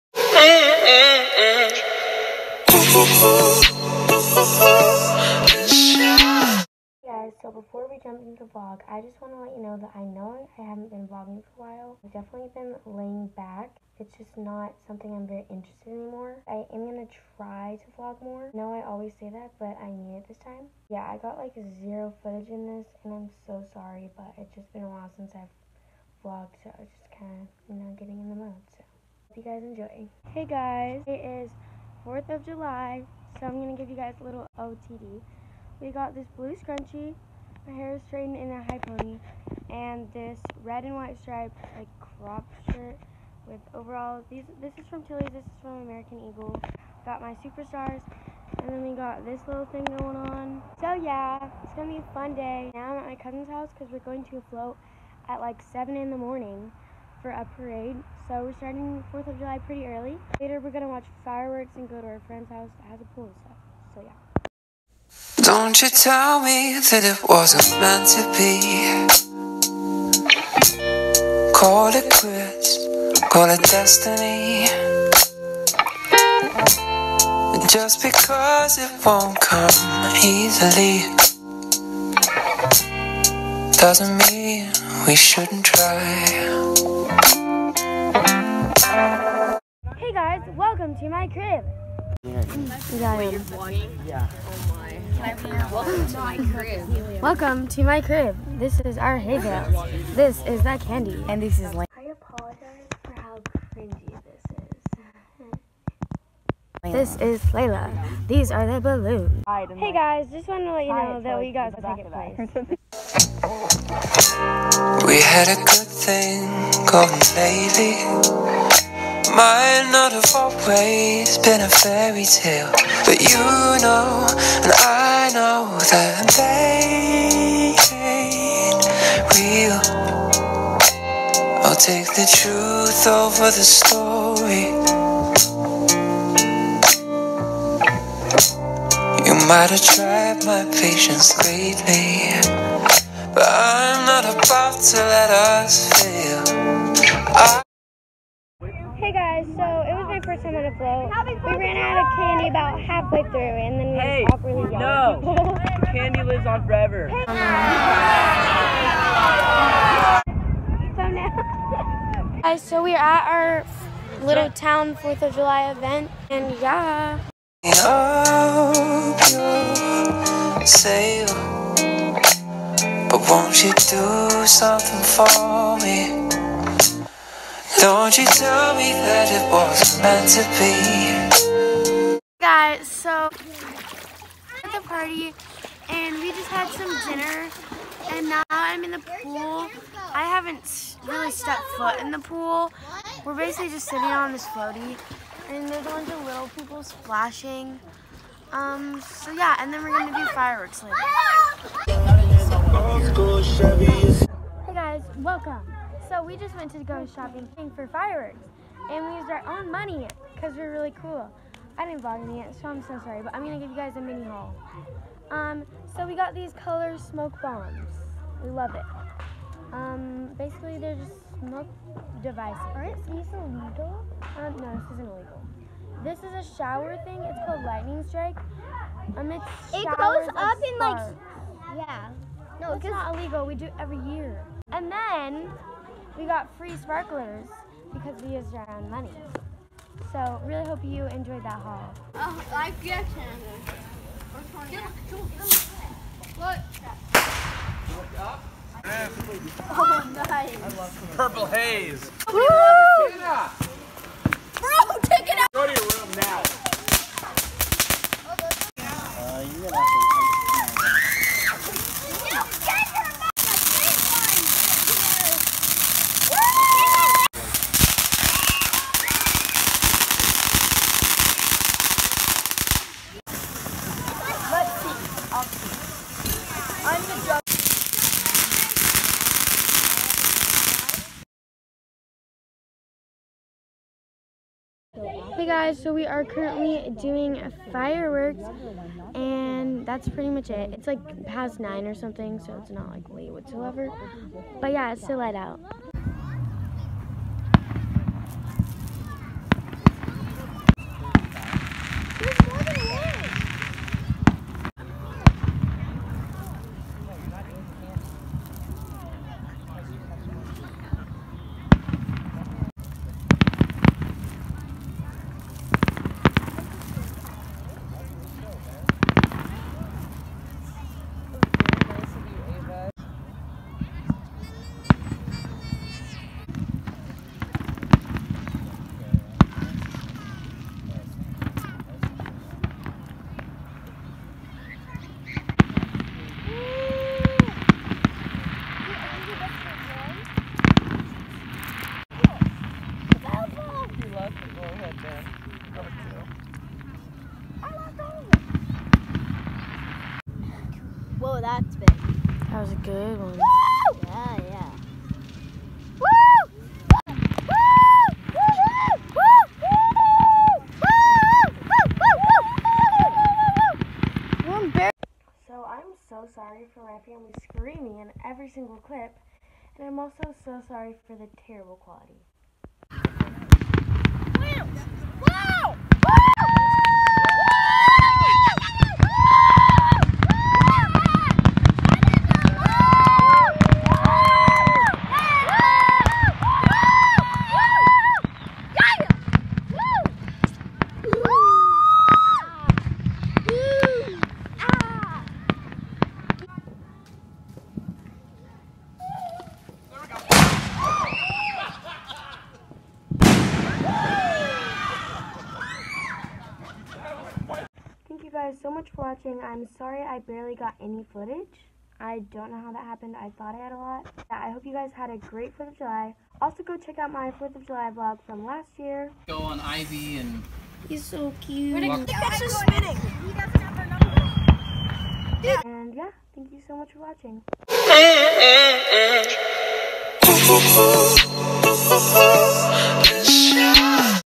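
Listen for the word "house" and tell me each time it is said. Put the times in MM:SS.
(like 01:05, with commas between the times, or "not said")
00:53, 01:02.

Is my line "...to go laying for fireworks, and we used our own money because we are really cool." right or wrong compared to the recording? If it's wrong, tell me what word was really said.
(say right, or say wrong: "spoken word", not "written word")
wrong: "shopping", not "laying".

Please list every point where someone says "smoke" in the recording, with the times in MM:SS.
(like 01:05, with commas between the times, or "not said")
03:36, 03:41.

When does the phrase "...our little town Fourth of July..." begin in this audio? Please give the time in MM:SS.
02:43.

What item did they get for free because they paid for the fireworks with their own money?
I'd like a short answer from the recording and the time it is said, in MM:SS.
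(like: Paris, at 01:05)
Sparklers, at 03:56.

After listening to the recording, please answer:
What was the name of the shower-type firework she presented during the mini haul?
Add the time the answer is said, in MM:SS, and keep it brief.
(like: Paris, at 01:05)
Lightning strike, at 03:47.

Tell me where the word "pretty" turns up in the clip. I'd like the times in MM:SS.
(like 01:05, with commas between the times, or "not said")
00:59, 04:50.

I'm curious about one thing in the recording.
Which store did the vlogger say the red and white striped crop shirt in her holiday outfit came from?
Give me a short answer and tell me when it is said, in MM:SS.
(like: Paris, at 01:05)
Tilly's, at 00:45.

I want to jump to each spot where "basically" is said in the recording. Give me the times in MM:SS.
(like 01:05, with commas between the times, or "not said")
03:13, 03:40.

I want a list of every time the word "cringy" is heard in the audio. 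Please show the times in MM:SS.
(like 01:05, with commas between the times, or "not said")
01:43.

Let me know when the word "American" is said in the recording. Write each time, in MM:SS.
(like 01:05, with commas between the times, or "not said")
00:45.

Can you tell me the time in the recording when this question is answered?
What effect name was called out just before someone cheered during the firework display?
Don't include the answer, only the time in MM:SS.
04:11.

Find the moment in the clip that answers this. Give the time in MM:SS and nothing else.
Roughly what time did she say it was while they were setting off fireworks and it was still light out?
04:51.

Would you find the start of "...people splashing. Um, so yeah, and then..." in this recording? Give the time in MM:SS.
03:16.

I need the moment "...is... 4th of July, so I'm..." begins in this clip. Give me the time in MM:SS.
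00:31.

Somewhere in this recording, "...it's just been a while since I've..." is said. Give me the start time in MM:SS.
00:24.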